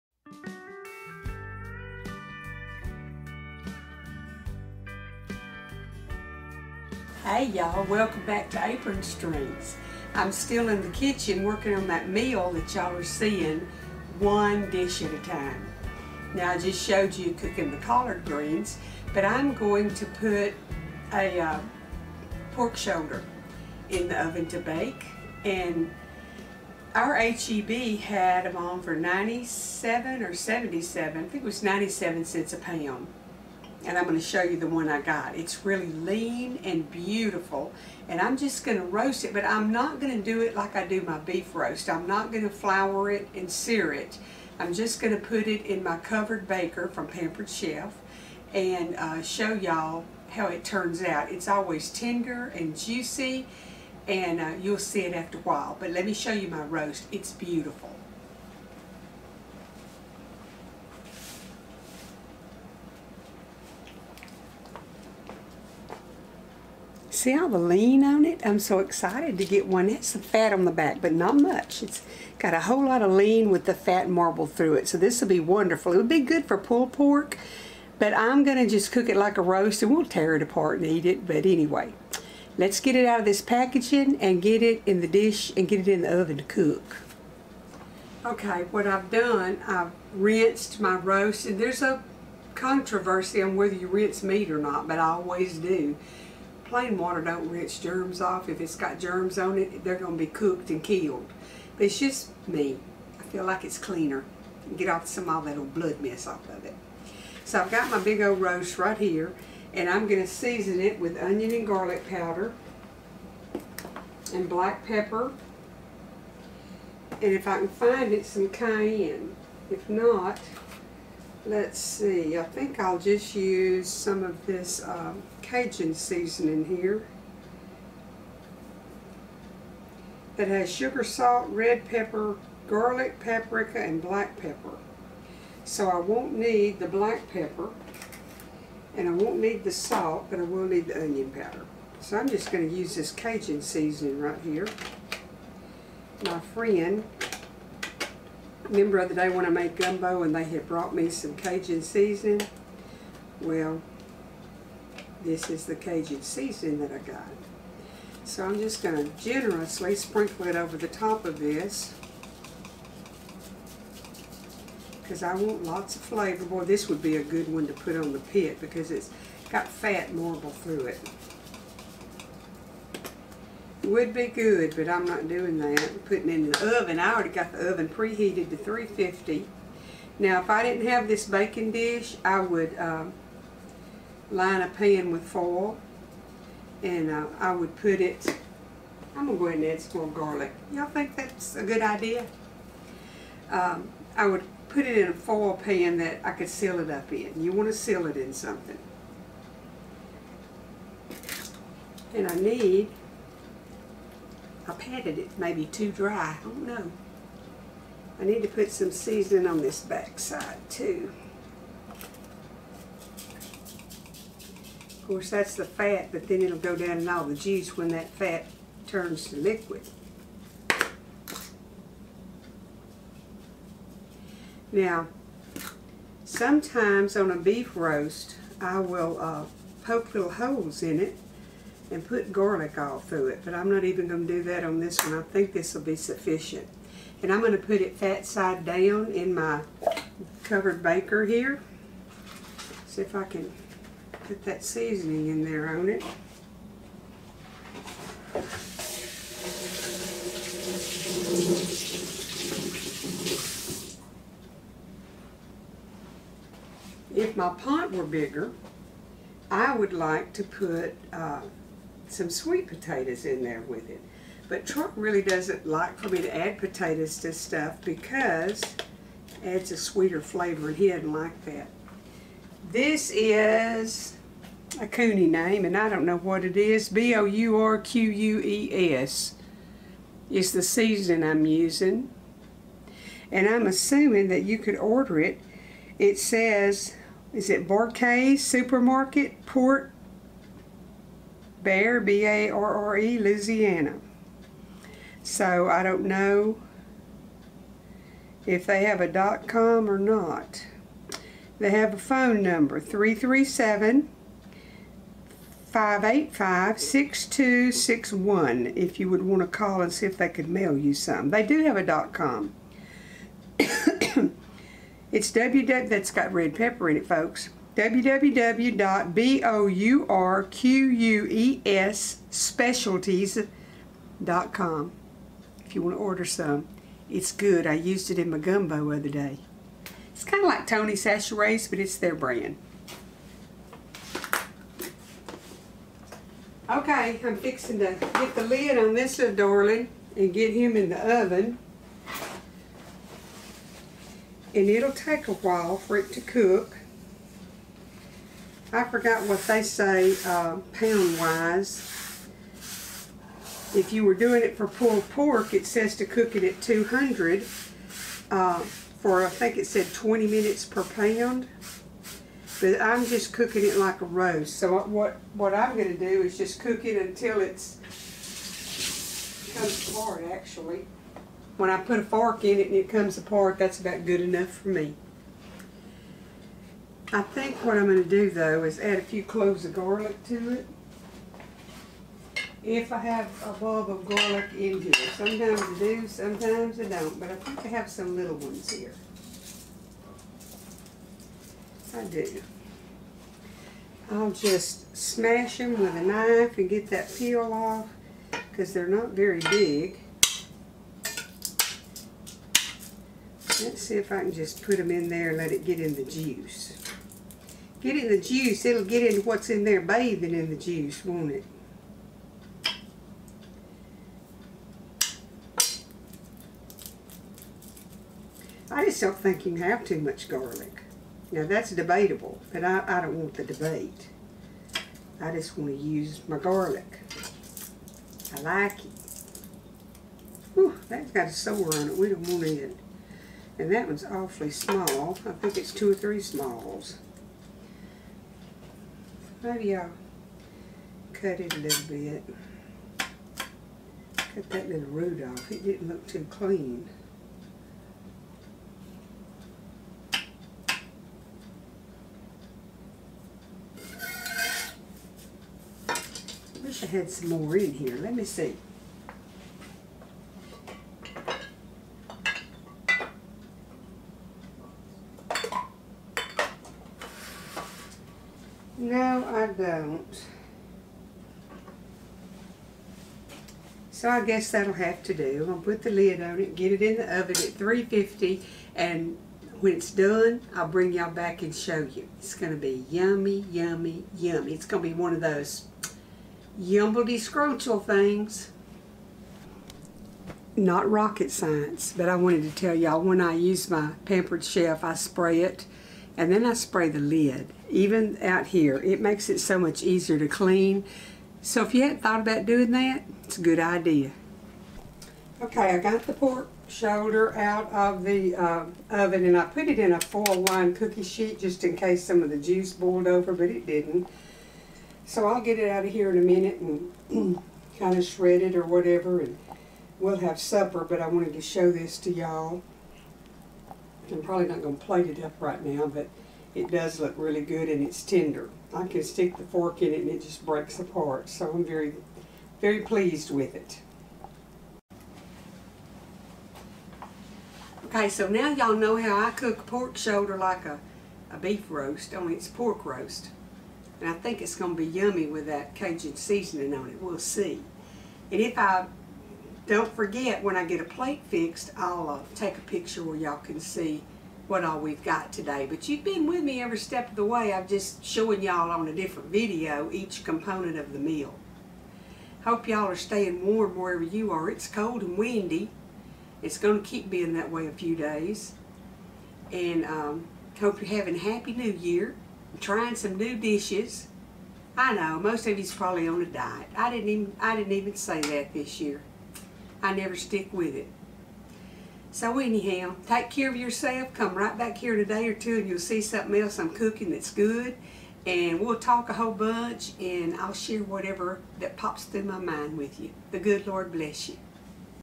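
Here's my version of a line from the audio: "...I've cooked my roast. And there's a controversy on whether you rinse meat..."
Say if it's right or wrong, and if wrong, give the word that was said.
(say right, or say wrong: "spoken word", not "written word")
wrong: "rinsed", not "cooked".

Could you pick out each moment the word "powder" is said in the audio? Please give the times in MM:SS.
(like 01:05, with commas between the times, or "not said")
01:52, 02:21.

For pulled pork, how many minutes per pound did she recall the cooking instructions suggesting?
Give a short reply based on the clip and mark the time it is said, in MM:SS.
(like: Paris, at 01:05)
20 minutes, at 05:59.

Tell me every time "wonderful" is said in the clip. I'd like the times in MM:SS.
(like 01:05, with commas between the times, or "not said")
01:15.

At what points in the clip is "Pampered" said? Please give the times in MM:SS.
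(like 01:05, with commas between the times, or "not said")
00:47, 08:14.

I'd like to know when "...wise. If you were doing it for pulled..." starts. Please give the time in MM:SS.
05:51.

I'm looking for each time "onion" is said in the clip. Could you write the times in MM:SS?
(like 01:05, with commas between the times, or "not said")
01:51, 02:21.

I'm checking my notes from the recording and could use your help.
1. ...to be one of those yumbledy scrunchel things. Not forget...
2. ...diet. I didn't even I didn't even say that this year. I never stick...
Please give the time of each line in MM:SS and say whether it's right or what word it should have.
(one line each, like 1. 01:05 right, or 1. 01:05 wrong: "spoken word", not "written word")
1. 08:04 wrong: "rocket", not "forget"
2. 09:36 right.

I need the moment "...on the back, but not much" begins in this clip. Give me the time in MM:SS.
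01:10.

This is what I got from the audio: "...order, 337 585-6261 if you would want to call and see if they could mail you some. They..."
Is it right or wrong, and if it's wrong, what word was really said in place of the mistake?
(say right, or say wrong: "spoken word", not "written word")
wrong: "number", not "order".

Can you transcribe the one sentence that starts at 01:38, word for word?
If it's got germs on it, they're going to be cooked and killed.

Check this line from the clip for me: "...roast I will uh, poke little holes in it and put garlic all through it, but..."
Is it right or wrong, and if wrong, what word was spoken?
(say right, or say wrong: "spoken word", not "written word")
right.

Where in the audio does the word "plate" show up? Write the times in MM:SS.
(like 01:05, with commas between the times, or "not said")
08:44, 09:10.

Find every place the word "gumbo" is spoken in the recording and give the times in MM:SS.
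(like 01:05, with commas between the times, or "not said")
02:29, 05:28.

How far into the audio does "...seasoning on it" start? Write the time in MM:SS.
09:06.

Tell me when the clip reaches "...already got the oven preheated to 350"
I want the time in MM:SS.
02:57.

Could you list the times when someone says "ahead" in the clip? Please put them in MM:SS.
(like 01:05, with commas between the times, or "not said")
03:09.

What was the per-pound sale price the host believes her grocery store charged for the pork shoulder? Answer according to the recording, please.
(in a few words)
97 cents.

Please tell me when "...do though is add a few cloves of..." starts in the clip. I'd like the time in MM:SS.
06:18.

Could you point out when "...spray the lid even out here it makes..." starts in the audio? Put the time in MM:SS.
08:16.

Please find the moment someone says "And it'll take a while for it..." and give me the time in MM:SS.
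05:44.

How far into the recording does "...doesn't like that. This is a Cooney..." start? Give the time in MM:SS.
04:30.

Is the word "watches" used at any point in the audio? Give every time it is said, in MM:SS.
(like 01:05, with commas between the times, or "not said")
not said.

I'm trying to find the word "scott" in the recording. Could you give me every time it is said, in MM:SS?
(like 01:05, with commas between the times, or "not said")
not said.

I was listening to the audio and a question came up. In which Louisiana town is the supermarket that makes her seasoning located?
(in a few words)
Port Barre.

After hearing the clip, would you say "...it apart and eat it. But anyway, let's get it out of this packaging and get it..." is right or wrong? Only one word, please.
right.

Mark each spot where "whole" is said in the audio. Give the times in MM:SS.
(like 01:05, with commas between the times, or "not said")
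01:12, 09:49.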